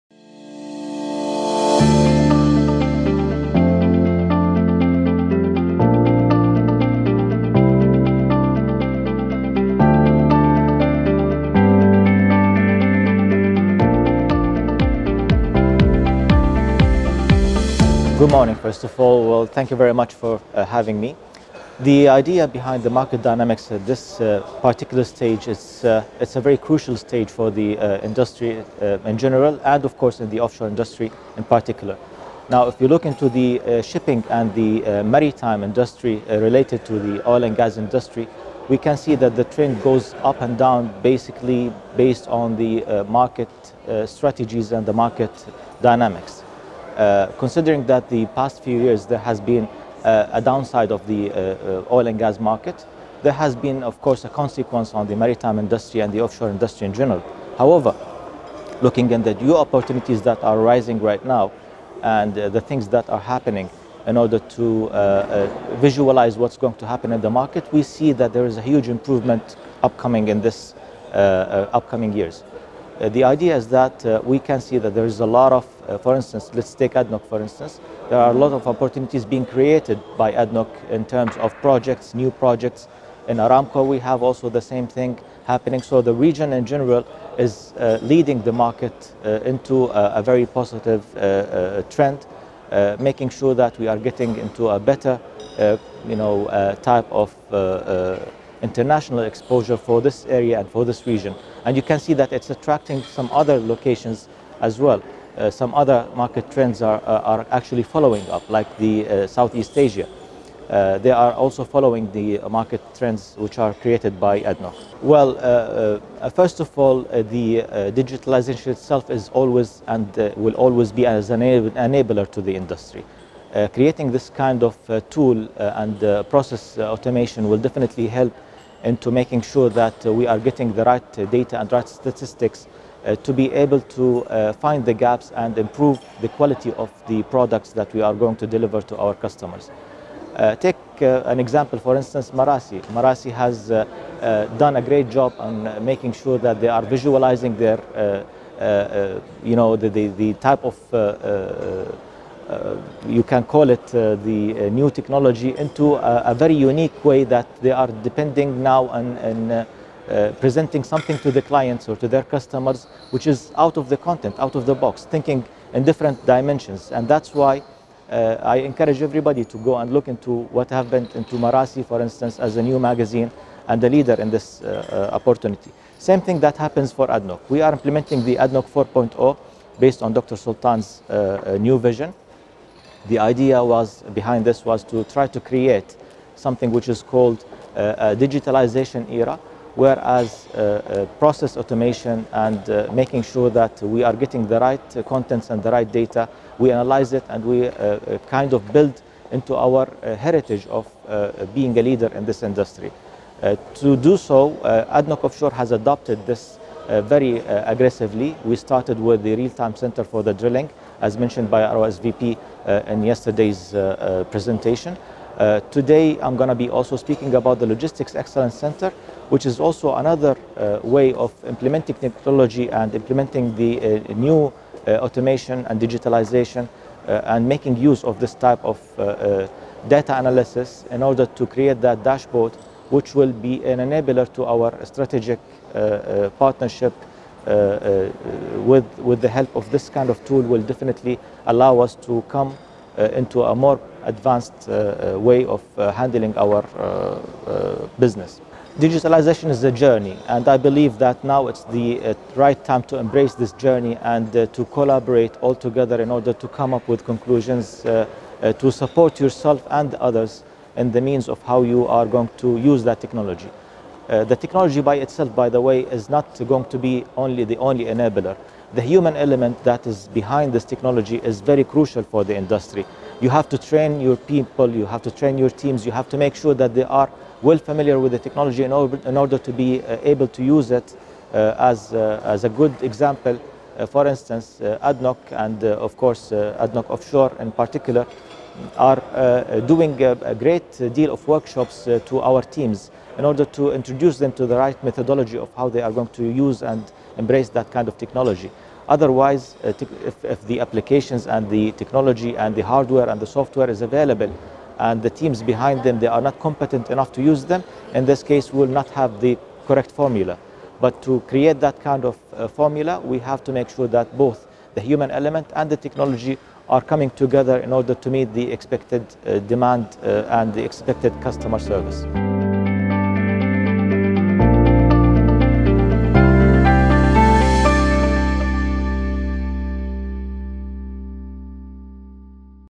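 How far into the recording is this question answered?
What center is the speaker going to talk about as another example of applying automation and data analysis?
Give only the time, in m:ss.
3:37.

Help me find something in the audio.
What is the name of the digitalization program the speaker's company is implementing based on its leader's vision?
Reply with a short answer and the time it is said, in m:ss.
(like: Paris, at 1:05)
ADNOC 4.0, at 2:58.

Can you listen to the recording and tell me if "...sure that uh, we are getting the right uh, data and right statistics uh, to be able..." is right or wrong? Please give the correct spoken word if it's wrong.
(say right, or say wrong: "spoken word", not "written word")
right.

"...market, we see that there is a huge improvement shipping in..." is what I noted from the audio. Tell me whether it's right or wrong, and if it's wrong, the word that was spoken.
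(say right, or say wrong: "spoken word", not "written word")
wrong: "upcoming", not "shipping".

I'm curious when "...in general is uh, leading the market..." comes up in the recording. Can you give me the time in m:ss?
1:26.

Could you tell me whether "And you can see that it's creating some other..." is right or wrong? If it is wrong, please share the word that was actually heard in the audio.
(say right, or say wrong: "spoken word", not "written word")
wrong: "attracting", not "creating".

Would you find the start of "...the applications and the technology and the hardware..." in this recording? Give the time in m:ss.
5:00.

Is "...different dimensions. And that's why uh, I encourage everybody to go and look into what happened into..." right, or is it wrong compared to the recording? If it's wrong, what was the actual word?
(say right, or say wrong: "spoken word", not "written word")
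right.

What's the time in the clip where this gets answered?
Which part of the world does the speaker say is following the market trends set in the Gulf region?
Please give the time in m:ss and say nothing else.
1:49.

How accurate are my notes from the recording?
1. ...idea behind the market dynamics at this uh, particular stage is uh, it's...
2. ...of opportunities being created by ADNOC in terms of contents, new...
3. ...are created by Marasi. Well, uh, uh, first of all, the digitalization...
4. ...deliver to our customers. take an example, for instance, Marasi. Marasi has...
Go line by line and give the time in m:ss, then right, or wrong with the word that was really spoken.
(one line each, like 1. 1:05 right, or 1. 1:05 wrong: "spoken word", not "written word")
1. 0:22 right
2. 1:18 wrong: "projects", not "contents"
3. 1:53 wrong: "ADNOC", not "Marasi"
4. 2:18 right.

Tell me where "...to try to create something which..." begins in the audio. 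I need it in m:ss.
3:04.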